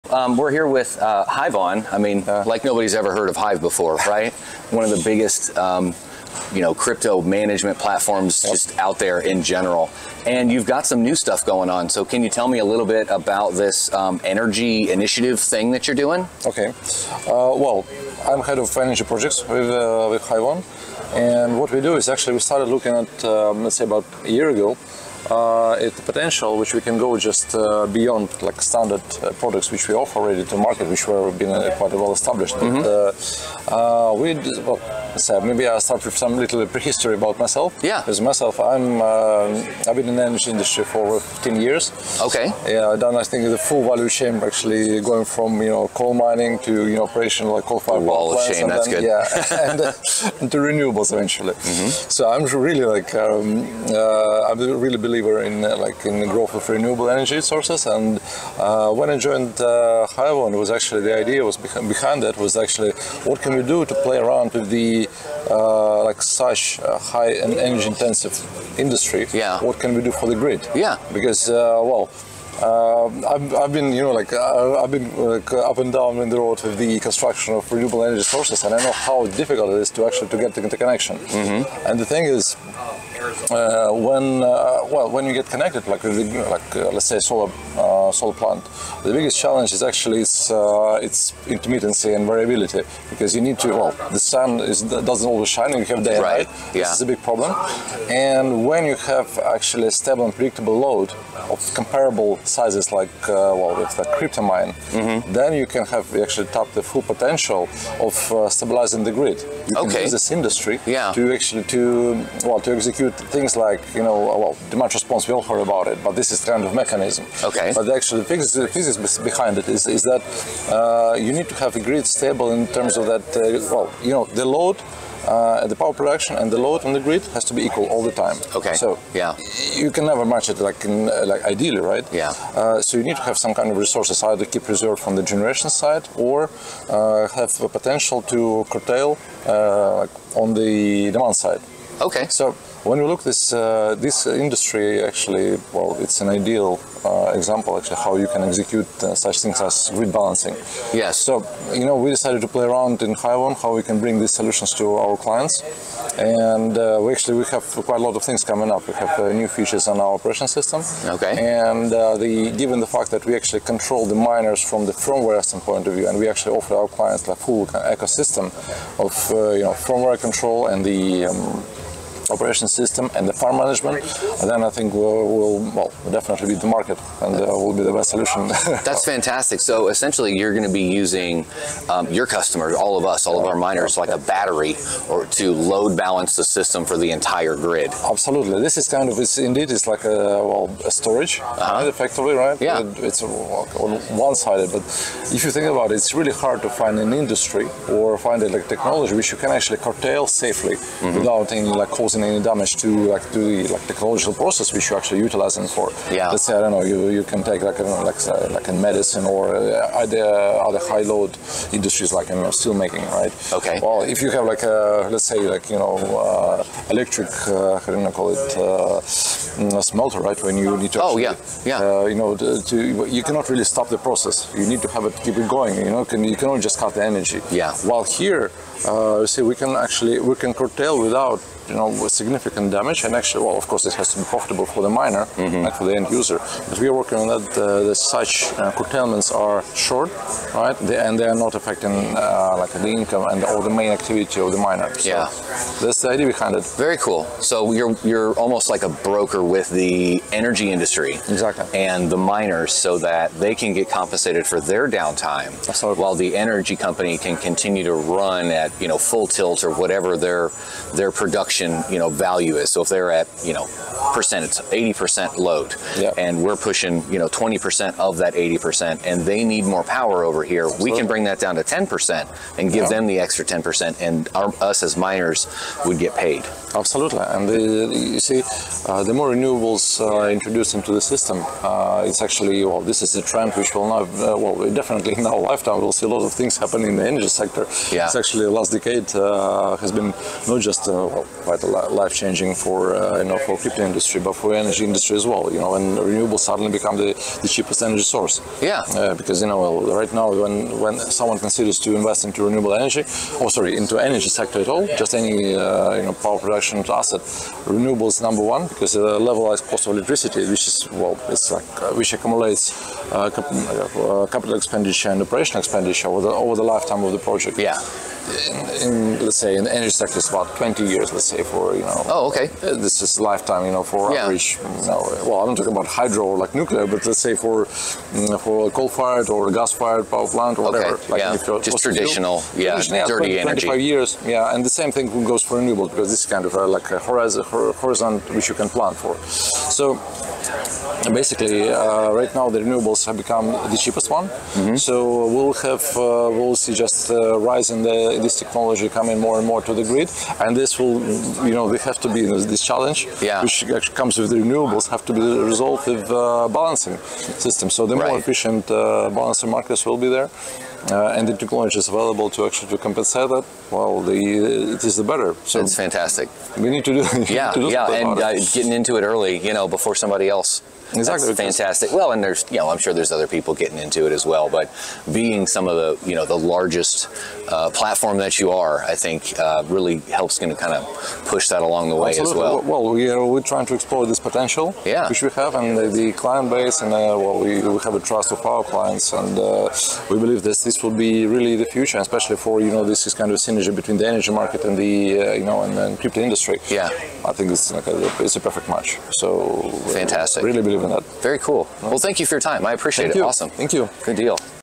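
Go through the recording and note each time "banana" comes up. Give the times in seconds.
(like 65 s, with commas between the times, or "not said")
not said.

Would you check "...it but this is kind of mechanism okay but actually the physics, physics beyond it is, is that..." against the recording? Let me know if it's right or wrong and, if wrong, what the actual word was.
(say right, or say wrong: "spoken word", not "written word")
wrong: "behind", not "beyond".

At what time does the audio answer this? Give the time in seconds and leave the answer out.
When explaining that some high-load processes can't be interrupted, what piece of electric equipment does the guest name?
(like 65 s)
219 s.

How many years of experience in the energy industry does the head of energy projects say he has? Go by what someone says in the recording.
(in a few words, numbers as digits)
over 15 years.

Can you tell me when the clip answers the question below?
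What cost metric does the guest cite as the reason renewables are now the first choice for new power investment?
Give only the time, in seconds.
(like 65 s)
309 s.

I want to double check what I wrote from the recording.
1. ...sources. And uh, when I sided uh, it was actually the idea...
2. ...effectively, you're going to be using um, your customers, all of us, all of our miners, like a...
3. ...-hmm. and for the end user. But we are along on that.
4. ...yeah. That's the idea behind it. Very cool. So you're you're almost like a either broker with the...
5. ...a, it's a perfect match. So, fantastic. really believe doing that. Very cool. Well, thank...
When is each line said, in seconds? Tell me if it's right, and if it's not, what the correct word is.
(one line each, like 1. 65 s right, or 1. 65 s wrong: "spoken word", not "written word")
1. 57 s wrong: "joined", not "sided"
2. 179 s wrong: "essentially", not "effectively"
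3. 235 s wrong: "working", not "along"
4. 245 s wrong: "broker", not "either"
5. 397 s right.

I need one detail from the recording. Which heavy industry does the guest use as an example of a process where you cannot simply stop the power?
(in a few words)
steel making.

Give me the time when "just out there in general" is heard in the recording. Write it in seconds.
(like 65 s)
8 s.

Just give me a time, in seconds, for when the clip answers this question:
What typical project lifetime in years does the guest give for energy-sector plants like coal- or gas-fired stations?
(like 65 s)
320 s.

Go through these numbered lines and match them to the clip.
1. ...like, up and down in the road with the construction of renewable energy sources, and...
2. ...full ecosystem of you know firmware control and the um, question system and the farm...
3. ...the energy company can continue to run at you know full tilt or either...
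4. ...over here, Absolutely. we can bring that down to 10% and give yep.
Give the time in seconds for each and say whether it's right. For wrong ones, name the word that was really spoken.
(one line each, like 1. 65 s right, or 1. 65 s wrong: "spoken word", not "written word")
1. 75 s right
2. 167 s wrong: "operation", not "question"
3. 256 s wrong: "whatever", not "either"
4. 270 s right.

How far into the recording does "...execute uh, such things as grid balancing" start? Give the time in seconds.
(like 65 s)
148 s.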